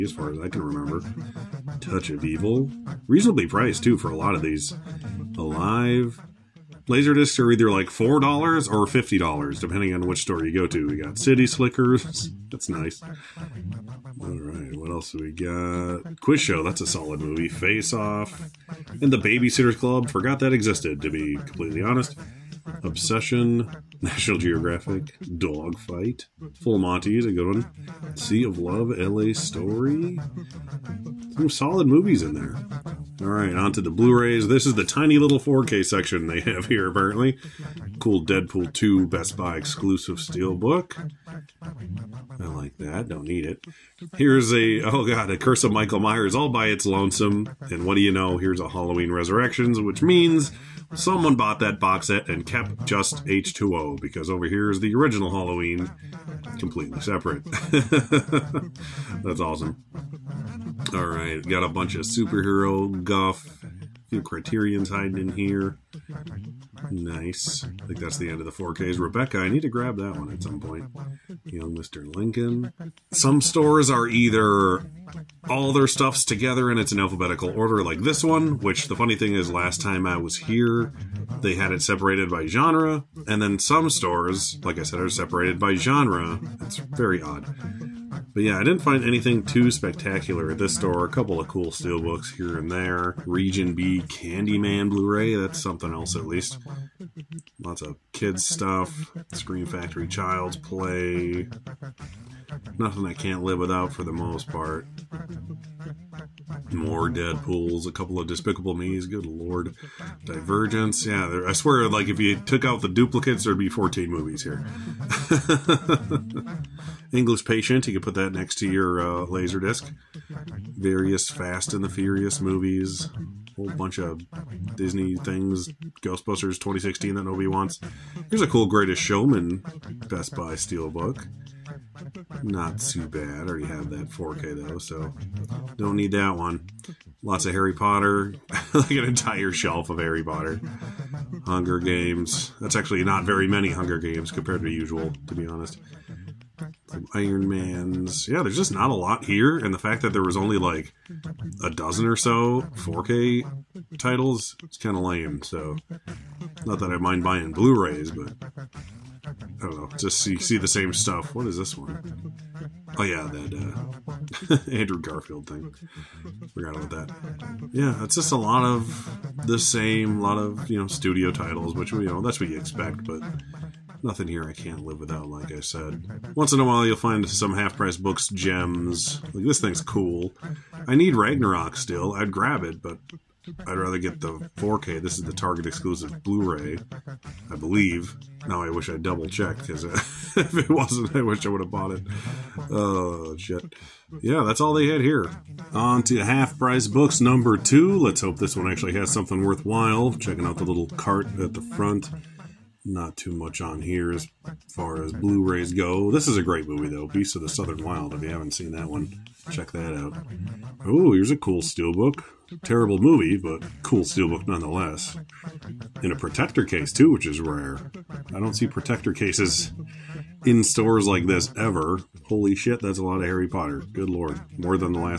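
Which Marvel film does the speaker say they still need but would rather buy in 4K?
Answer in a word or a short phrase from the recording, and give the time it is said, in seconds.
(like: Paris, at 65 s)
Ragnarok, at 181 s.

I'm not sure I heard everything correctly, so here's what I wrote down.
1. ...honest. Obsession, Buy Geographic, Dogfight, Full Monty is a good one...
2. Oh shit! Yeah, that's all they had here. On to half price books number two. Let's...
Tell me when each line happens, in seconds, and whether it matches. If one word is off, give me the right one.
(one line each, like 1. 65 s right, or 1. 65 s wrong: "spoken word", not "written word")
1. 21 s wrong: "National", not "Buy"
2. 192 s right.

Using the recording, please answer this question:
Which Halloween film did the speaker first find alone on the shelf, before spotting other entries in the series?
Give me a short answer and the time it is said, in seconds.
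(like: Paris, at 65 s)
Curse of Michael Myers, at 45 s.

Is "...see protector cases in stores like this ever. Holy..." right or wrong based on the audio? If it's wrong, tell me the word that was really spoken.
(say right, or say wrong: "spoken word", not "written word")
right.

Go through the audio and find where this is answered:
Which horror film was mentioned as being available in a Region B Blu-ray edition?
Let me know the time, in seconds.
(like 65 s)
94 s.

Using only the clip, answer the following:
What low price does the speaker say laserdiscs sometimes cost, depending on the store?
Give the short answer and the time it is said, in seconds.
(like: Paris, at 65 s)
$4, at 7 s.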